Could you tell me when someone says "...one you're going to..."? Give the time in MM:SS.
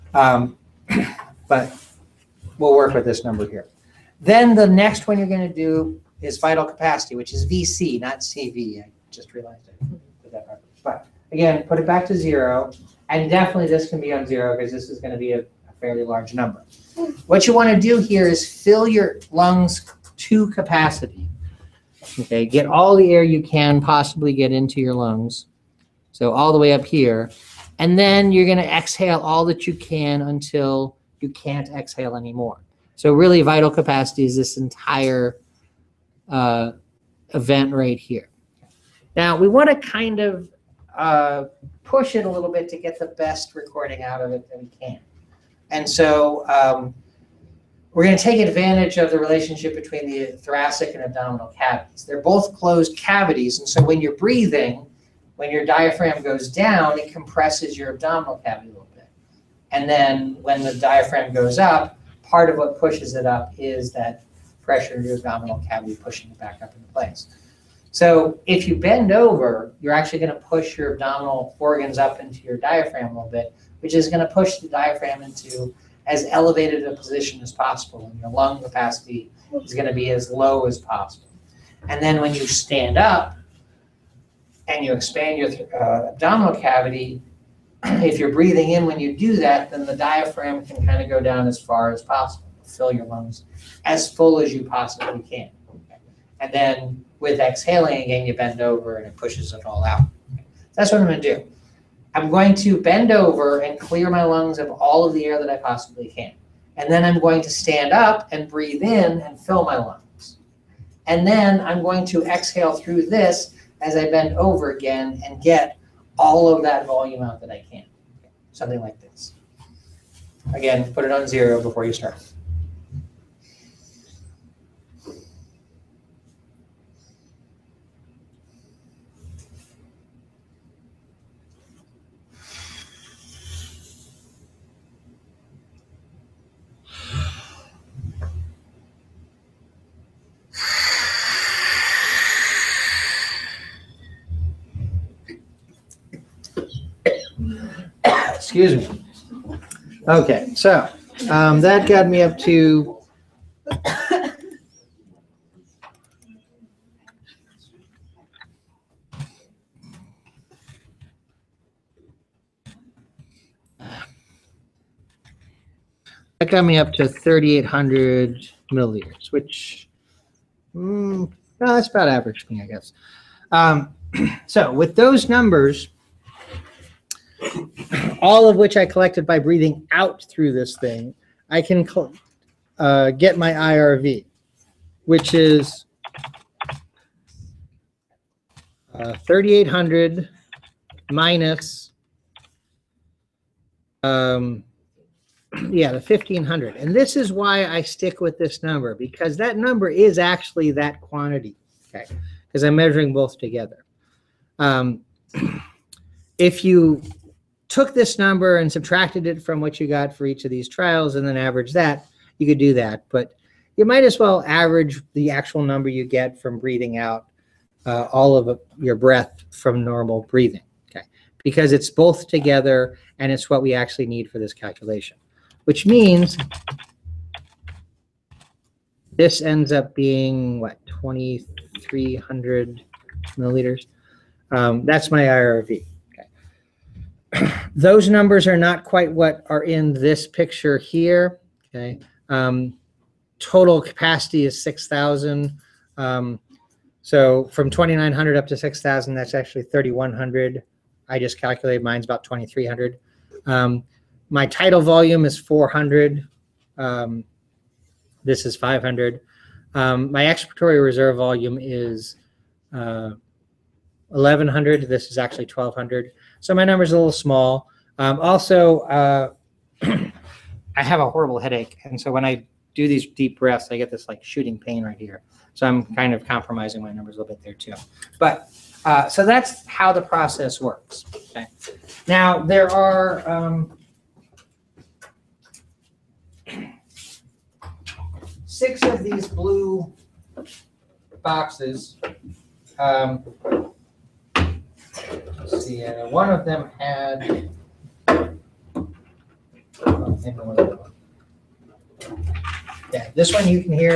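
00:05.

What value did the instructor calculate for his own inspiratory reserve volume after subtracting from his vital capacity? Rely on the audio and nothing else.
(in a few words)
2,300 milliliters.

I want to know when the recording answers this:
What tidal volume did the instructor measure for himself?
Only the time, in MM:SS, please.
04:15.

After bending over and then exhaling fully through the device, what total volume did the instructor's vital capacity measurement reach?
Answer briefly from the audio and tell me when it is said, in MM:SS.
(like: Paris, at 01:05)
3,800 milliliters, at 02:47.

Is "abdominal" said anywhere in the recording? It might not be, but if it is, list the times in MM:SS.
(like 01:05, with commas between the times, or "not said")
00:51, 00:57, 01:05, 01:10, 01:26.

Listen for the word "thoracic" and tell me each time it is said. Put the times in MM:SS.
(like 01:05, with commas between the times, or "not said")
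00:50.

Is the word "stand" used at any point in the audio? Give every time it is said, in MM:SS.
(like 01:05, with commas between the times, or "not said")
01:22, 01:47.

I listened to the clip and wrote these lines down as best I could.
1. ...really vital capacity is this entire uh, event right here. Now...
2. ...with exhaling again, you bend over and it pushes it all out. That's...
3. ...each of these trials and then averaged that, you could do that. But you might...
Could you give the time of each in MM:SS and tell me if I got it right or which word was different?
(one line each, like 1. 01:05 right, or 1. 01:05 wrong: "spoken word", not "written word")
1. 00:33 right
2. 01:37 right
3. 03:30 right.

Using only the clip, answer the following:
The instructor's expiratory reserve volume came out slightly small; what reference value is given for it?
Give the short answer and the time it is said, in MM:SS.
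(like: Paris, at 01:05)
1,200, at 04:25.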